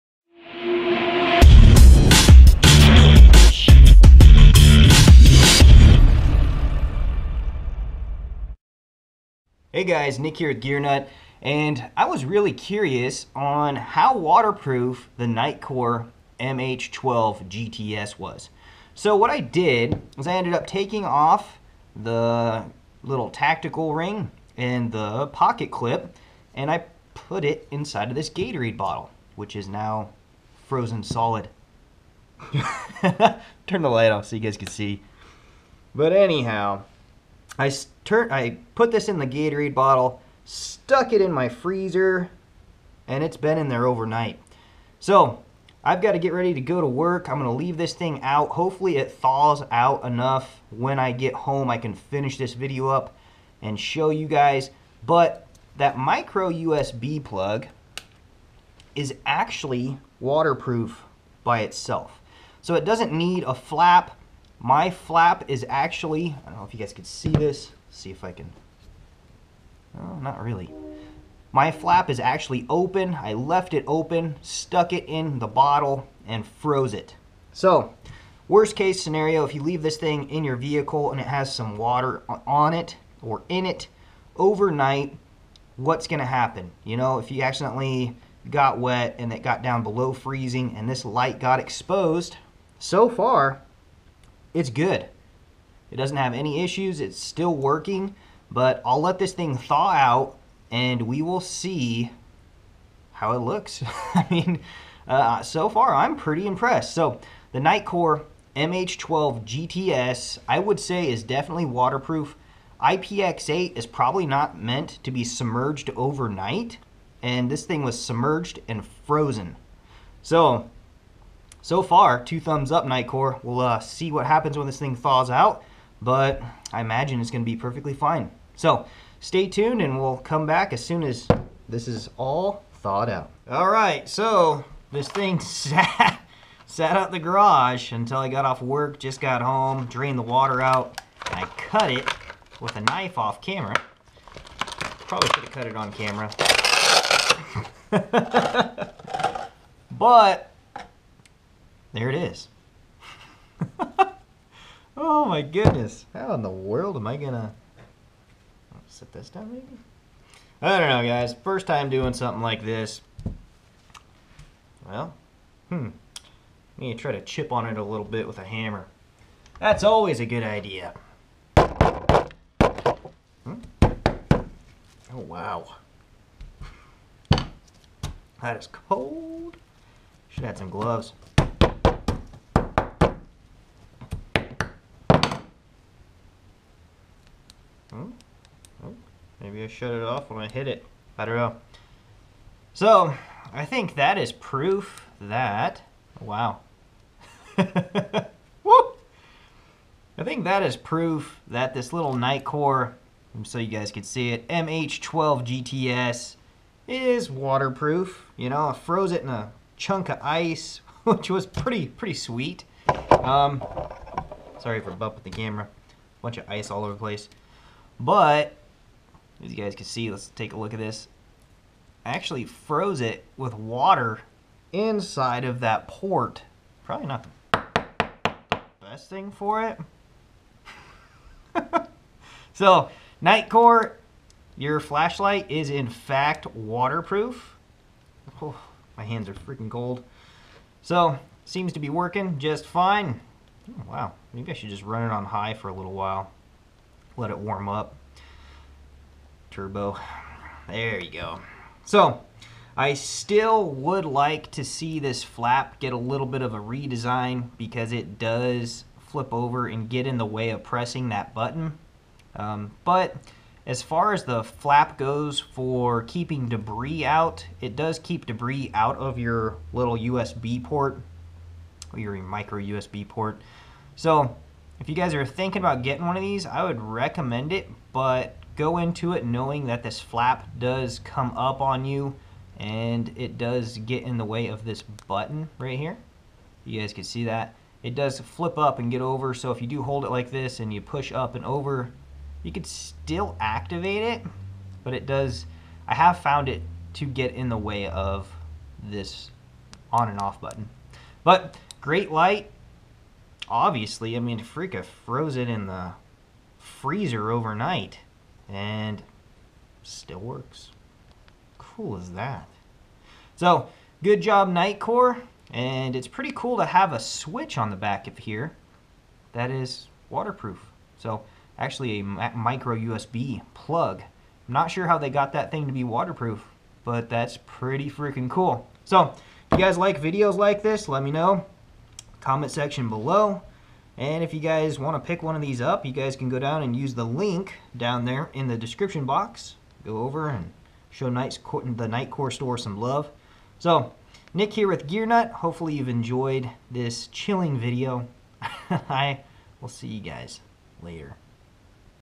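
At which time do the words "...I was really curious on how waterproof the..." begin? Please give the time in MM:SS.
00:11.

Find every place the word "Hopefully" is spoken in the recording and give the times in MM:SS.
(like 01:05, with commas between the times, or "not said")
00:48, 05:45.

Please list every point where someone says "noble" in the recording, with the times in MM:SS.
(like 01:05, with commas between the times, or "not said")
not said.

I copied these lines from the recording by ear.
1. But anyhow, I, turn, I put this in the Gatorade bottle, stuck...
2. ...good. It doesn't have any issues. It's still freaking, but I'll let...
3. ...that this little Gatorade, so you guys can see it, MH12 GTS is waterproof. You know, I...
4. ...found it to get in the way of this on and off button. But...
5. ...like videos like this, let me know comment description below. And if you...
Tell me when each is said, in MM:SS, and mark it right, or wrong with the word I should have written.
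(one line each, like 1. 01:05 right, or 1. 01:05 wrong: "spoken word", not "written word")
1. 00:35 right
2. 01:34 wrong: "working", not "freaking"
3. 03:21 wrong: "Nitecore", not "Gatorade"
4. 04:56 right
5. 05:29 wrong: "section", not "description".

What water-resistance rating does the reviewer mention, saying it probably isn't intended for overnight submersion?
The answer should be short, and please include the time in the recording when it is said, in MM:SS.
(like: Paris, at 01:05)
IPX8, at 01:52.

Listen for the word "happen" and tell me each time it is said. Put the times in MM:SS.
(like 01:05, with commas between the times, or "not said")
01:26, 02:04.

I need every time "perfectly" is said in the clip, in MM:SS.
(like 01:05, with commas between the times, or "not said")
02:07.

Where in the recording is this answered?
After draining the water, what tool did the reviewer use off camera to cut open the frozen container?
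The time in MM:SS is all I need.
02:22.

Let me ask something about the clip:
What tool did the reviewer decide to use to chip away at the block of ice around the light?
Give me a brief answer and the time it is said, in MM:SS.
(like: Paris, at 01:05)
a hammer, at 02:48.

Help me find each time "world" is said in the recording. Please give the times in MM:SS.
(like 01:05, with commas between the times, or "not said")
02:36.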